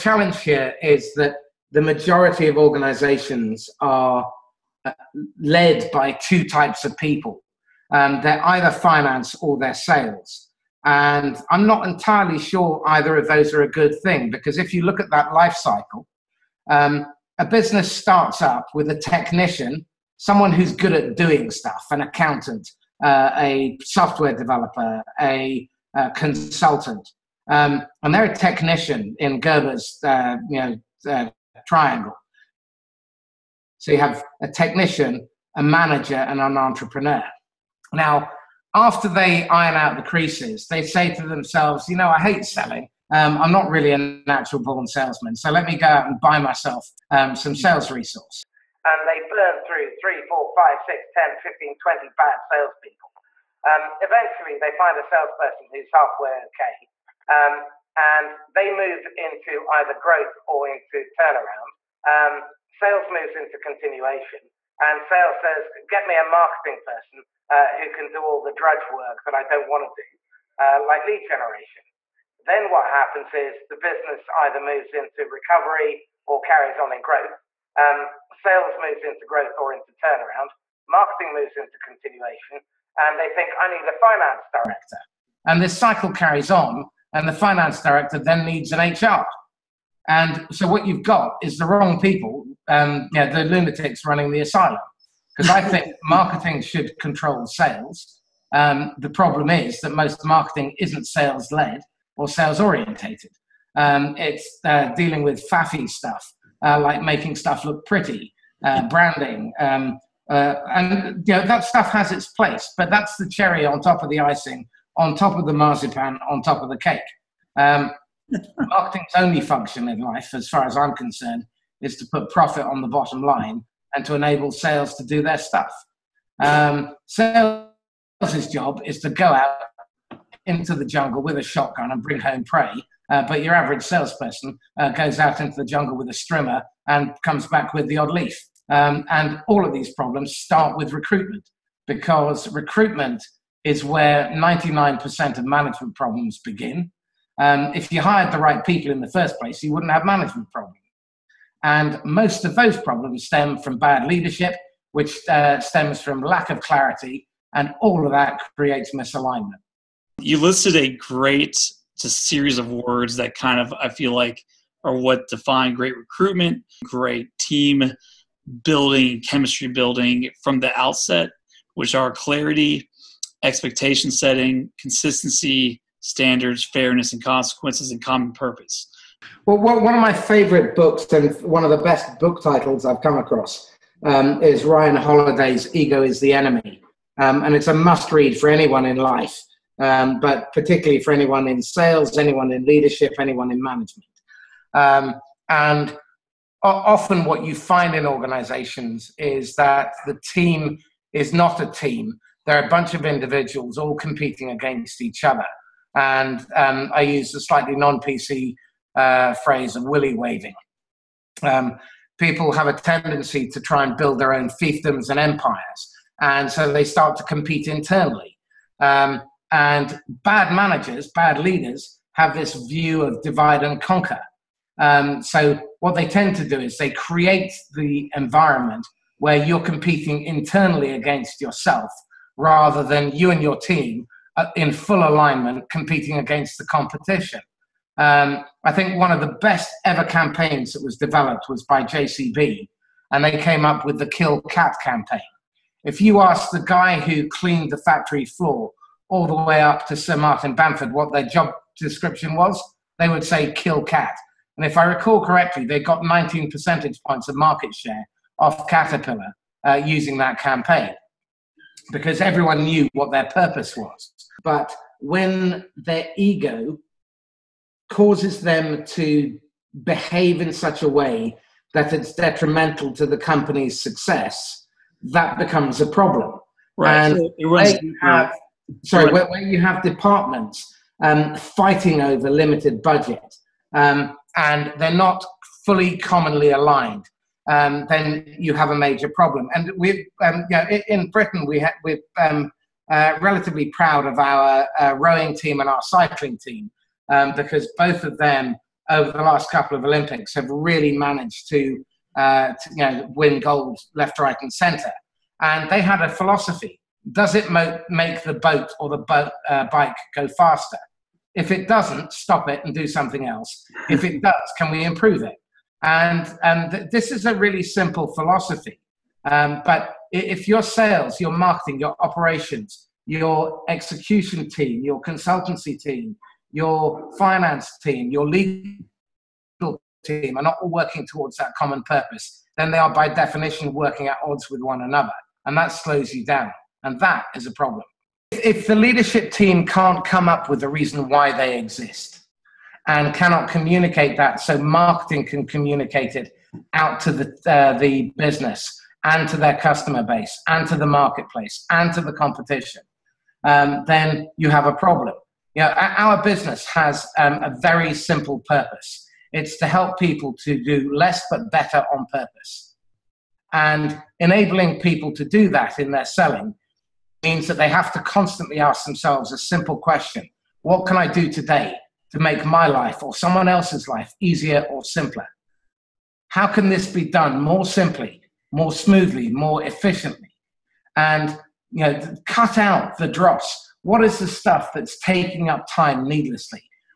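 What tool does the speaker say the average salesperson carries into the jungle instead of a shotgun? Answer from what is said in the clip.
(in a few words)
A strimmer.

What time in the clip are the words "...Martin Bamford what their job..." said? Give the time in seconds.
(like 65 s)
250 s.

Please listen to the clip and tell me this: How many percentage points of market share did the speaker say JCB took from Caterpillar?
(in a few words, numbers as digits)
19.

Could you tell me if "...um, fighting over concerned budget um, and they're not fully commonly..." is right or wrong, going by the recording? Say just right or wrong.
wrong.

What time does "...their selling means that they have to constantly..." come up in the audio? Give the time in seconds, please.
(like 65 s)
365 s.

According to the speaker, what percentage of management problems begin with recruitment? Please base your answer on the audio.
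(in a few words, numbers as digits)
99%.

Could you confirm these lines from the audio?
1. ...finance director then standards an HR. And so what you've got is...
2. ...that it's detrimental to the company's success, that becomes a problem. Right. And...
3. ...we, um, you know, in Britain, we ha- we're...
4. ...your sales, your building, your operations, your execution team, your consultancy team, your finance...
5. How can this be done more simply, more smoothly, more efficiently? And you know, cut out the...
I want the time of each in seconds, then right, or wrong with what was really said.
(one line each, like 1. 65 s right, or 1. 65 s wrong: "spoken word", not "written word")
1. 87 s wrong: "needs", not "standards"
2. 271 s right
3. 289 s right
4. 320 s wrong: "marketing", not "building"
5. 376 s right.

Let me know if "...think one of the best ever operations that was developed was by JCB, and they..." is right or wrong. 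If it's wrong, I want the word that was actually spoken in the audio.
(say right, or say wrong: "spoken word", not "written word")
wrong: "campaigns", not "operations".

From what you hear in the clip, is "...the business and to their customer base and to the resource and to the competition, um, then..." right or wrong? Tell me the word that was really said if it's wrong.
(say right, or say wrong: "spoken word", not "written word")
wrong: "marketplace", not "resource".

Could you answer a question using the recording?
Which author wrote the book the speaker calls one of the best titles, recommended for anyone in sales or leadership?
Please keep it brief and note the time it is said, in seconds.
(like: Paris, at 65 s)
Ryan Holiday, at 184 s.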